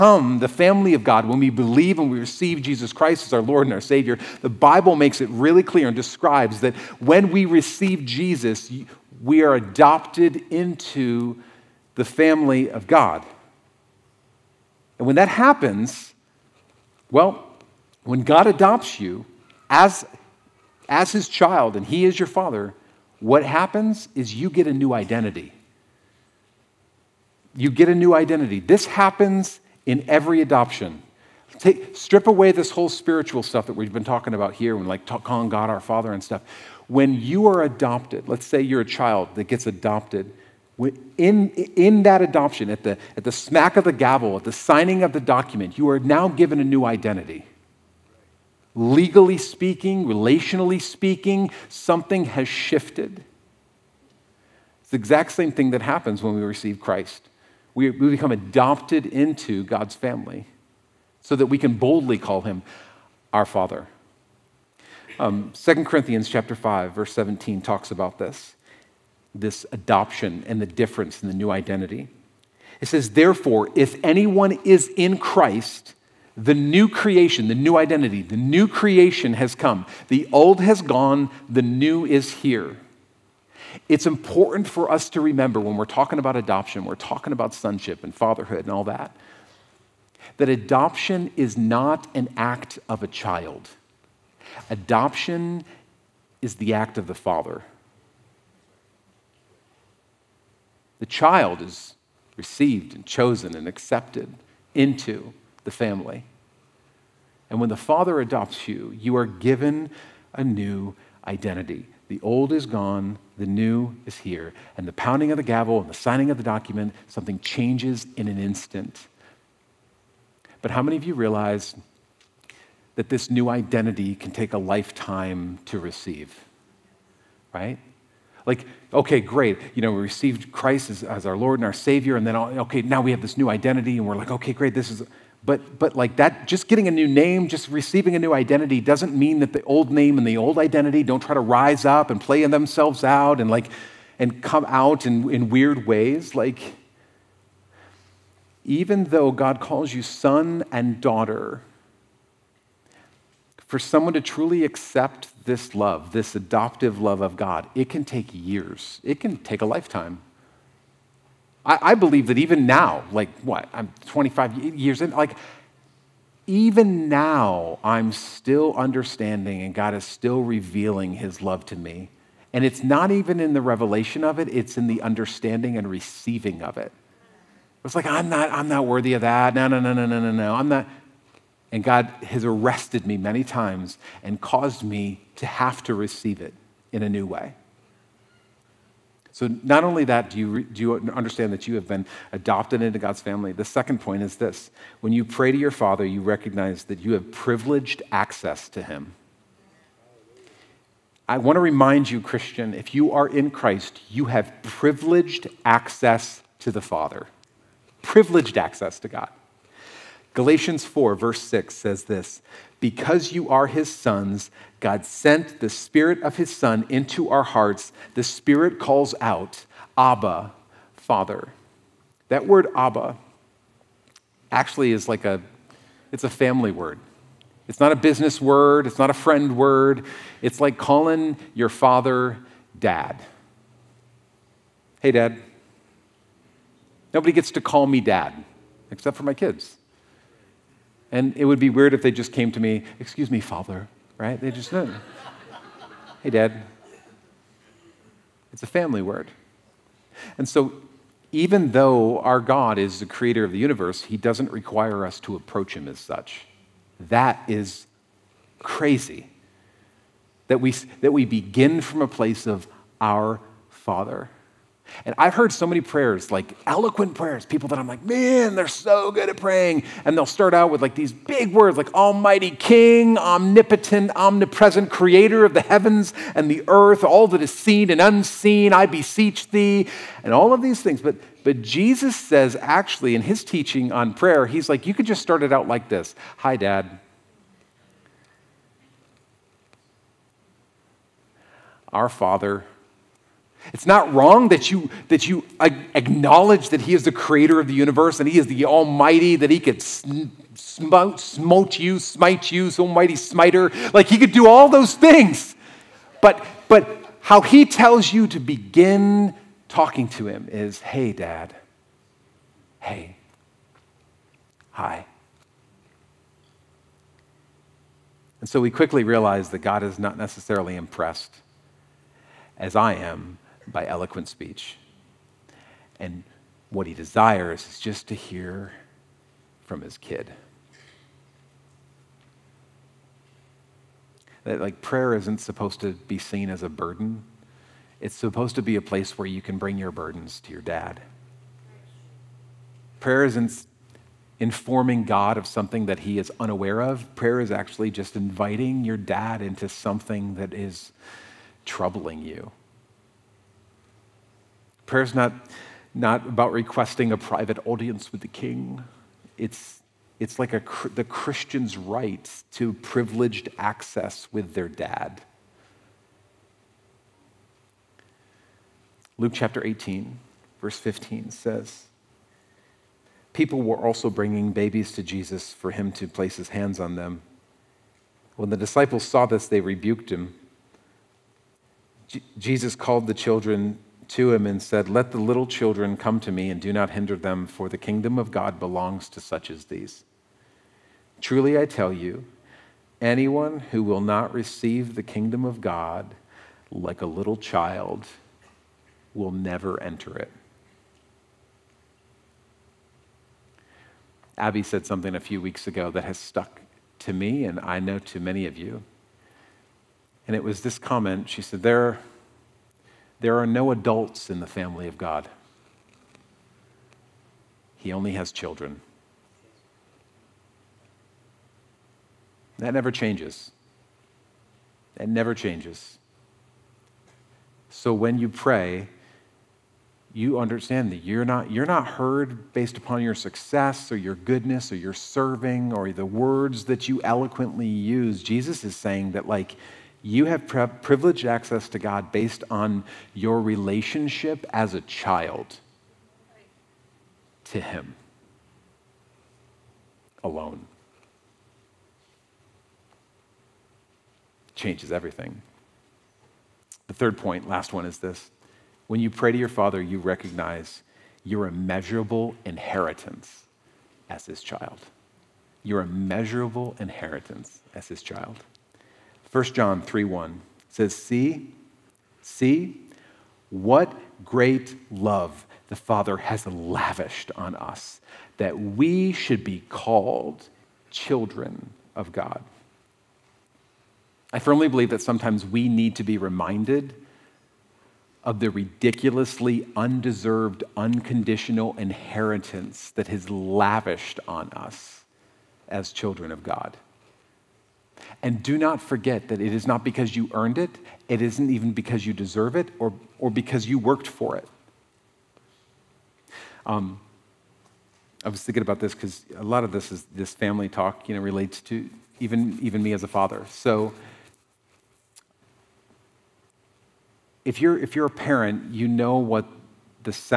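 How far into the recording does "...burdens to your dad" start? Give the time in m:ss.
5:39.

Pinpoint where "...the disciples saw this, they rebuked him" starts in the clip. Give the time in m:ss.
6:18.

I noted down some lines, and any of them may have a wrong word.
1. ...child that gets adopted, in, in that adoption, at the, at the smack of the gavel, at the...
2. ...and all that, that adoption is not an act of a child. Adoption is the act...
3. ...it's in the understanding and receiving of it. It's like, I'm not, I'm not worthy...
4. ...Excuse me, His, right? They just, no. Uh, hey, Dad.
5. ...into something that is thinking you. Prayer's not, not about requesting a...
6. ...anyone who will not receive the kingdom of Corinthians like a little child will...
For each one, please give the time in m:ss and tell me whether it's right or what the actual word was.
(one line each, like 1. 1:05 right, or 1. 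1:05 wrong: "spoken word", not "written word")
1. 0:38 right
2. 1:28 right
3. 2:54 right
4. 4:02 wrong: "Father", not "His"
5. 5:49 wrong: "troubling", not "thinking"
6. 6:33 wrong: "God", not "Corinthians".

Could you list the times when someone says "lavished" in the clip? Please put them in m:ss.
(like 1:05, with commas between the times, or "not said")
7:56, 8:13.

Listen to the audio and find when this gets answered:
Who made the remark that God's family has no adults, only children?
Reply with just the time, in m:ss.
6:44.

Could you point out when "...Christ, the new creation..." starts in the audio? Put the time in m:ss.
1:15.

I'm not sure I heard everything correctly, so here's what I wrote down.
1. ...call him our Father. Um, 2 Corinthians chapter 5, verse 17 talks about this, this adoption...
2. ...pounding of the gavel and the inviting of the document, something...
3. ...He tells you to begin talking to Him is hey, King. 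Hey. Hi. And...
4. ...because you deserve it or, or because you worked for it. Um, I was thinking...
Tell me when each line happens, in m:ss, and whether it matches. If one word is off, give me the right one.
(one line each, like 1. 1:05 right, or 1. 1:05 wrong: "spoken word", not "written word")
1. 1:02 right
2. 1:54 wrong: "signing", not "inviting"
3. 5:07 wrong: "Dad", not "King"
4. 8:21 right.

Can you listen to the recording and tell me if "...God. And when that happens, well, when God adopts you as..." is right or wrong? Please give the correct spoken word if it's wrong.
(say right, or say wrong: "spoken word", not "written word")
right.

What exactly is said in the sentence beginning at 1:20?
The old has gone, the new is here.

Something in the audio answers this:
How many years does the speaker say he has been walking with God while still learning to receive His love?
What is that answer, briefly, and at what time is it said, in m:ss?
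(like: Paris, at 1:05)
25, at 2:44.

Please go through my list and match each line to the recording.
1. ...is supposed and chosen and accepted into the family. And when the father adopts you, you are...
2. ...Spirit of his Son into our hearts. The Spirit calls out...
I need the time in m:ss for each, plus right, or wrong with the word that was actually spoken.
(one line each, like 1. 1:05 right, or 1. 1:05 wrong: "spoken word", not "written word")
1. 1:41 wrong: "received", not "supposed"
2. 3:35 right.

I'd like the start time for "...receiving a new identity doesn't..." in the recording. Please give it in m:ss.
2:17.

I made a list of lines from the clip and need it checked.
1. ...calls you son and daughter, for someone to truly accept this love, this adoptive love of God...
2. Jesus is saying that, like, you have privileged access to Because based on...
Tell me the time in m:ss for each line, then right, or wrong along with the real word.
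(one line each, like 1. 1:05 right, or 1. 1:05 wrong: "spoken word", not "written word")
1. 2:29 right
2. 7:18 wrong: "God", not "Because".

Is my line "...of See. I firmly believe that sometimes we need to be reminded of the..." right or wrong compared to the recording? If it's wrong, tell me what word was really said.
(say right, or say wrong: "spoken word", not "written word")
wrong: "God", not "See".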